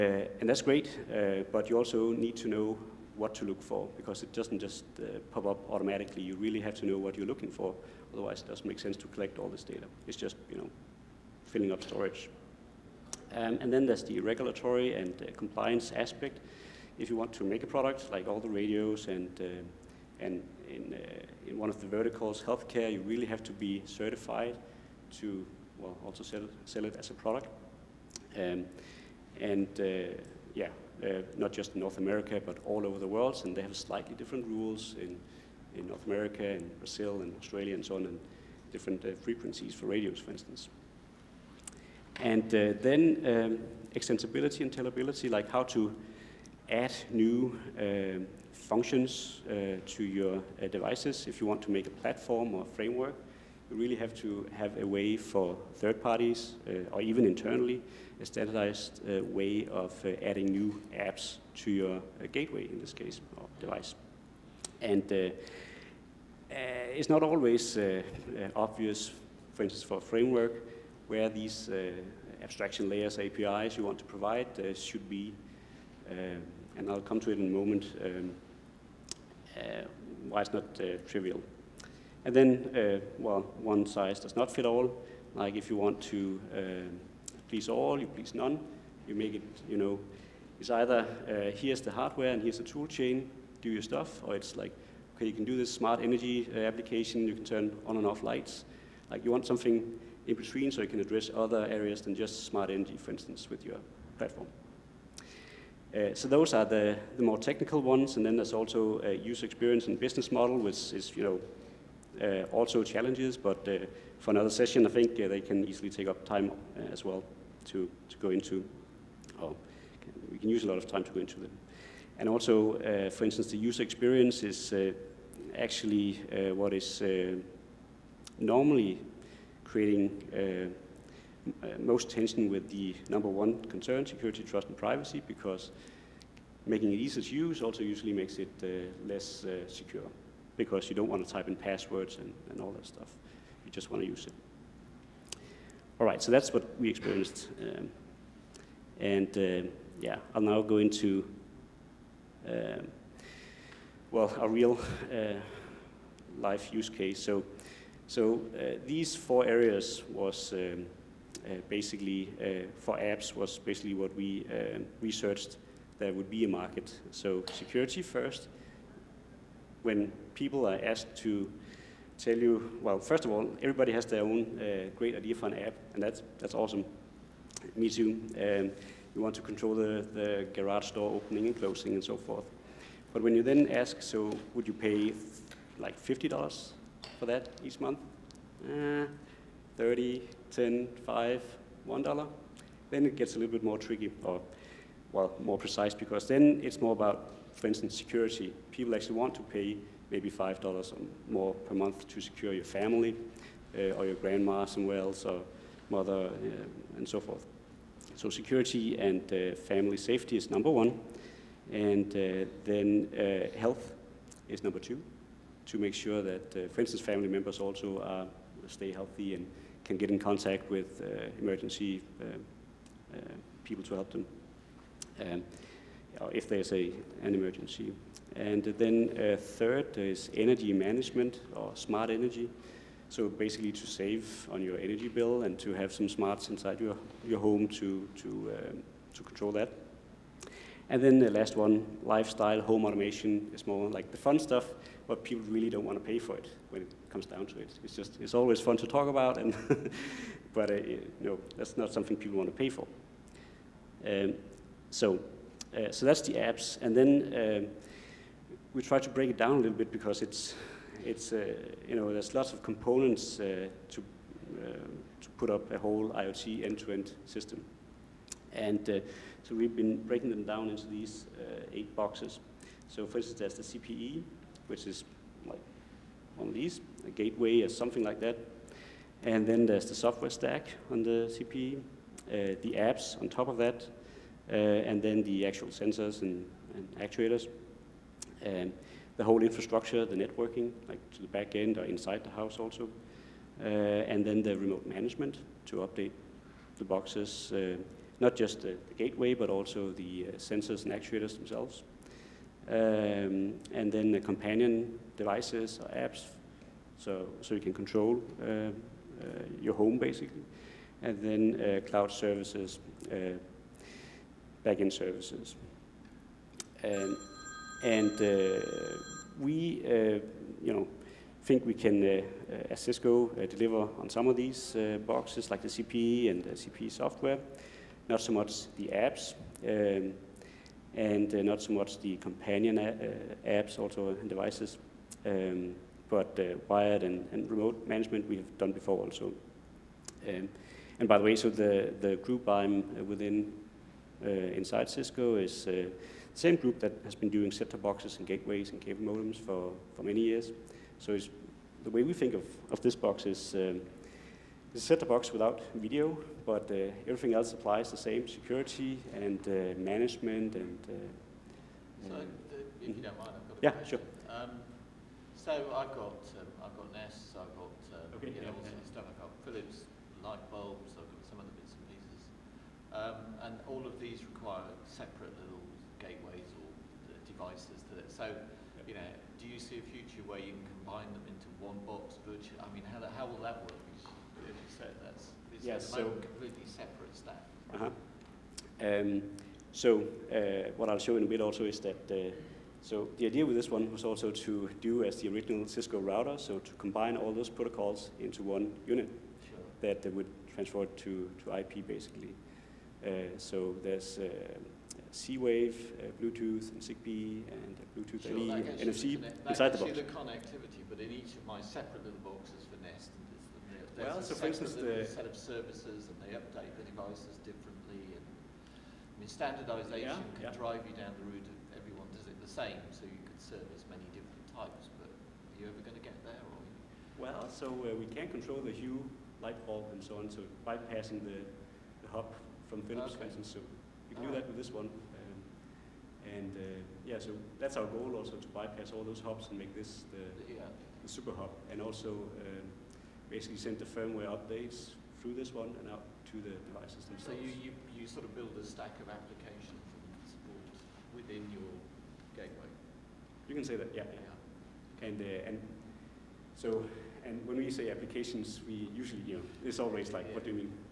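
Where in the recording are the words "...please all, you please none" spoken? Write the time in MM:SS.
01:27.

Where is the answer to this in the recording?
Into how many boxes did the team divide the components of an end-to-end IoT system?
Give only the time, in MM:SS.
04:31.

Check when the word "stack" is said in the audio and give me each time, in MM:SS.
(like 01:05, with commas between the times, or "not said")
04:40, 06:27, 07:28.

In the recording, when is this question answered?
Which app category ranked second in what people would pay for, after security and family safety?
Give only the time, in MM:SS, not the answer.
03:33.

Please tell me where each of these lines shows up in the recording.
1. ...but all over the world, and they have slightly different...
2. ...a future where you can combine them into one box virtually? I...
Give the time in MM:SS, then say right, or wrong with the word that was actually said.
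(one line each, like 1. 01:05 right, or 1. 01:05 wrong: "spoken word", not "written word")
1. 00:32 right
2. 06:19 right.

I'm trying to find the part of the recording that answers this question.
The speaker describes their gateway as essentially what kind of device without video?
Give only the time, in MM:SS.
05:54.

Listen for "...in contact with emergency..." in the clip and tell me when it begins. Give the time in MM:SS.
03:40.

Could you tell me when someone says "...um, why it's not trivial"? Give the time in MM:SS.
01:18.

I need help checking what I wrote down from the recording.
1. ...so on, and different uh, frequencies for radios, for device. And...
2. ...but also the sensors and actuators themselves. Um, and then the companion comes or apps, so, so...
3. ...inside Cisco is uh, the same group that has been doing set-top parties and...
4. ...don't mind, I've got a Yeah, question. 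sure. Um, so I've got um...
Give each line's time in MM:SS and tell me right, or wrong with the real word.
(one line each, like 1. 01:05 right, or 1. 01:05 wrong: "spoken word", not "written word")
1. 00:37 wrong: "instance", not "device"
2. 04:59 wrong: "devices", not "comes"
3. 05:44 wrong: "boxes", not "parties"
4. 06:02 right.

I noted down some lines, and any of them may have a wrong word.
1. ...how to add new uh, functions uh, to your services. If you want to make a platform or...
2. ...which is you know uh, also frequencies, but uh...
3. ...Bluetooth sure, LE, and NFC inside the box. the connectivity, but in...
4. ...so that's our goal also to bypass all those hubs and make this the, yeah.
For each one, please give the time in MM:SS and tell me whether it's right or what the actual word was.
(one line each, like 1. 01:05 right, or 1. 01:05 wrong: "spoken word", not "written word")
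1. 00:45 wrong: "devices", not "services"
2. 01:50 wrong: "challenges", not "frequencies"
3. 06:47 right
4. 07:17 right.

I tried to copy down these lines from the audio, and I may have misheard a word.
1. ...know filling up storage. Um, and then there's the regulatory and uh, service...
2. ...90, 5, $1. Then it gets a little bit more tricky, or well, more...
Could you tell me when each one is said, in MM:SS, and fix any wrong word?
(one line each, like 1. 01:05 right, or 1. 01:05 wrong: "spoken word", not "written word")
1. 00:10 wrong: "compliance", not "service"
2. 03:10 wrong: "10", not "90".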